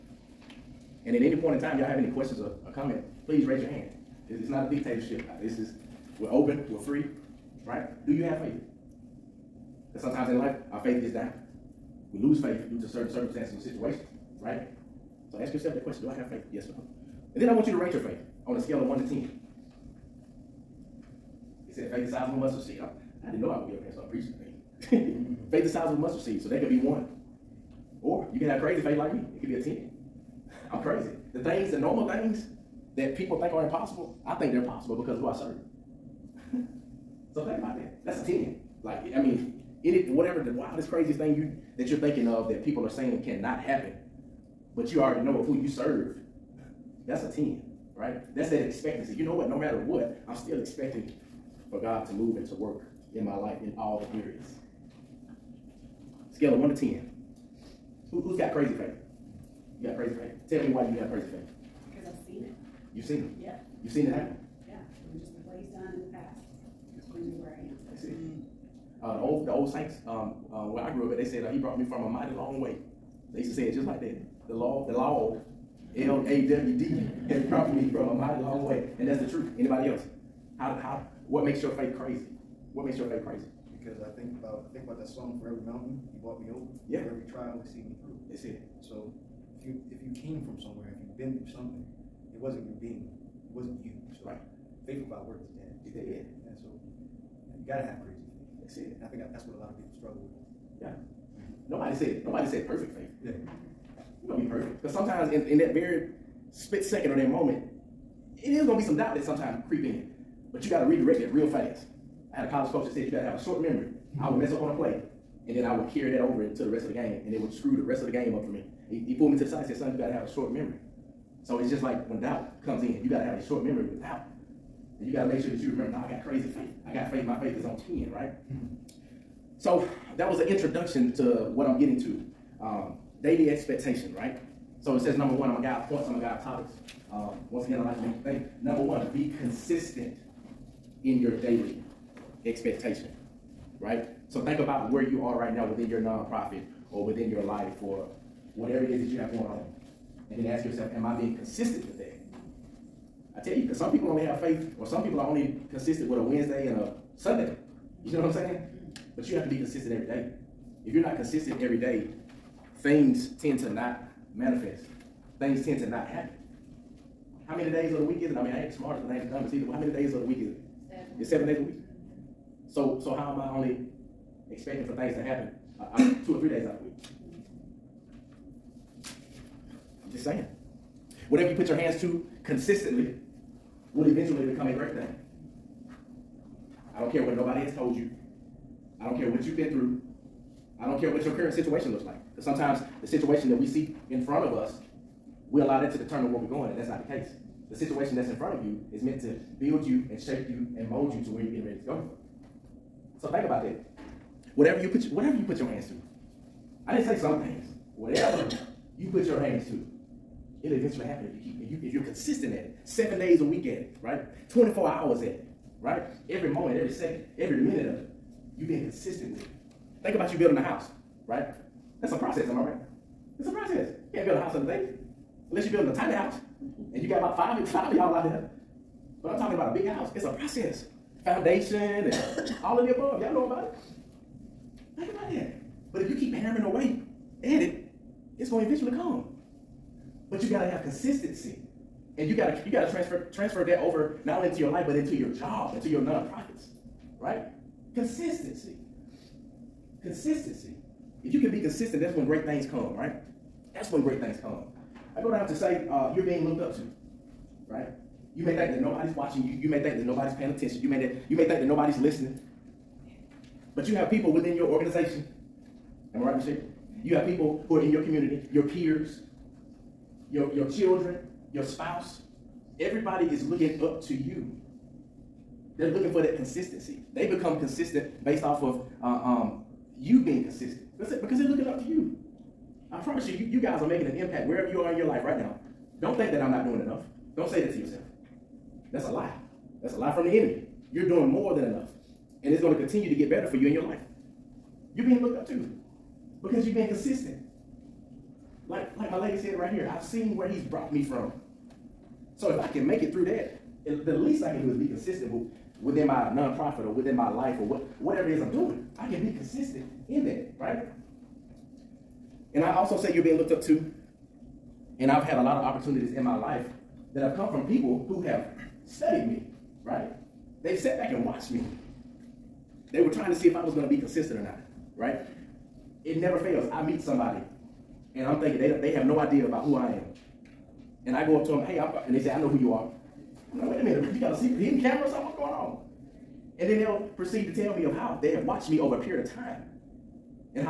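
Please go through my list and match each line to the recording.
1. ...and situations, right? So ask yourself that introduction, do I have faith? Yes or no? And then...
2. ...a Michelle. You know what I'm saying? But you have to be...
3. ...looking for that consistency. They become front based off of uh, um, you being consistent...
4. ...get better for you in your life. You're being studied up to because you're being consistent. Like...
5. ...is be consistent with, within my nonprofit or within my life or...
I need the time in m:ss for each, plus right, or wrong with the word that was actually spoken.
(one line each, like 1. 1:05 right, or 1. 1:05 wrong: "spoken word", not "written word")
1. 0:13 wrong: "question", not "introduction"
2. 2:36 wrong: "Sunday", not "Michelle"
3. 4:35 wrong: "consistent", not "front"
4. 4:53 wrong: "looked", not "studied"
5. 5:04 right.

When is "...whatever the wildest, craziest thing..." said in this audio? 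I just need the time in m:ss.
0:40.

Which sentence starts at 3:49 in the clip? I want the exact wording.
But I'm talking about a big house.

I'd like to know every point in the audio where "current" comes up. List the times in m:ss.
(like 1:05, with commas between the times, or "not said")
3:11.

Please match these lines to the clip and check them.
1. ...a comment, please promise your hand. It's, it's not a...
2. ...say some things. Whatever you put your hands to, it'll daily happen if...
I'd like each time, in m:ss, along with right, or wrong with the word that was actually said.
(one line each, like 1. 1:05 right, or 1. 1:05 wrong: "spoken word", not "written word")
1. 0:02 wrong: "raise", not "promise"
2. 3:27 wrong: "eventually", not "daily".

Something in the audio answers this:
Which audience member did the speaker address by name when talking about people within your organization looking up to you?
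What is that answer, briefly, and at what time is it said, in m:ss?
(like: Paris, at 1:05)
Michelle, at 4:26.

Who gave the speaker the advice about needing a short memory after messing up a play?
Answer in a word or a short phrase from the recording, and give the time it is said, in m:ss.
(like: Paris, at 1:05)
college coach, at 1:52.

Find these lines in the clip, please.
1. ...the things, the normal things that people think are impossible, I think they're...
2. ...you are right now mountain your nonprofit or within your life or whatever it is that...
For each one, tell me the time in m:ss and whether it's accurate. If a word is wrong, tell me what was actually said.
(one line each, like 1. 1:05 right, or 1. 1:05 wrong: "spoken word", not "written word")
1. 0:31 right
2. 2:25 wrong: "within", not "mountain".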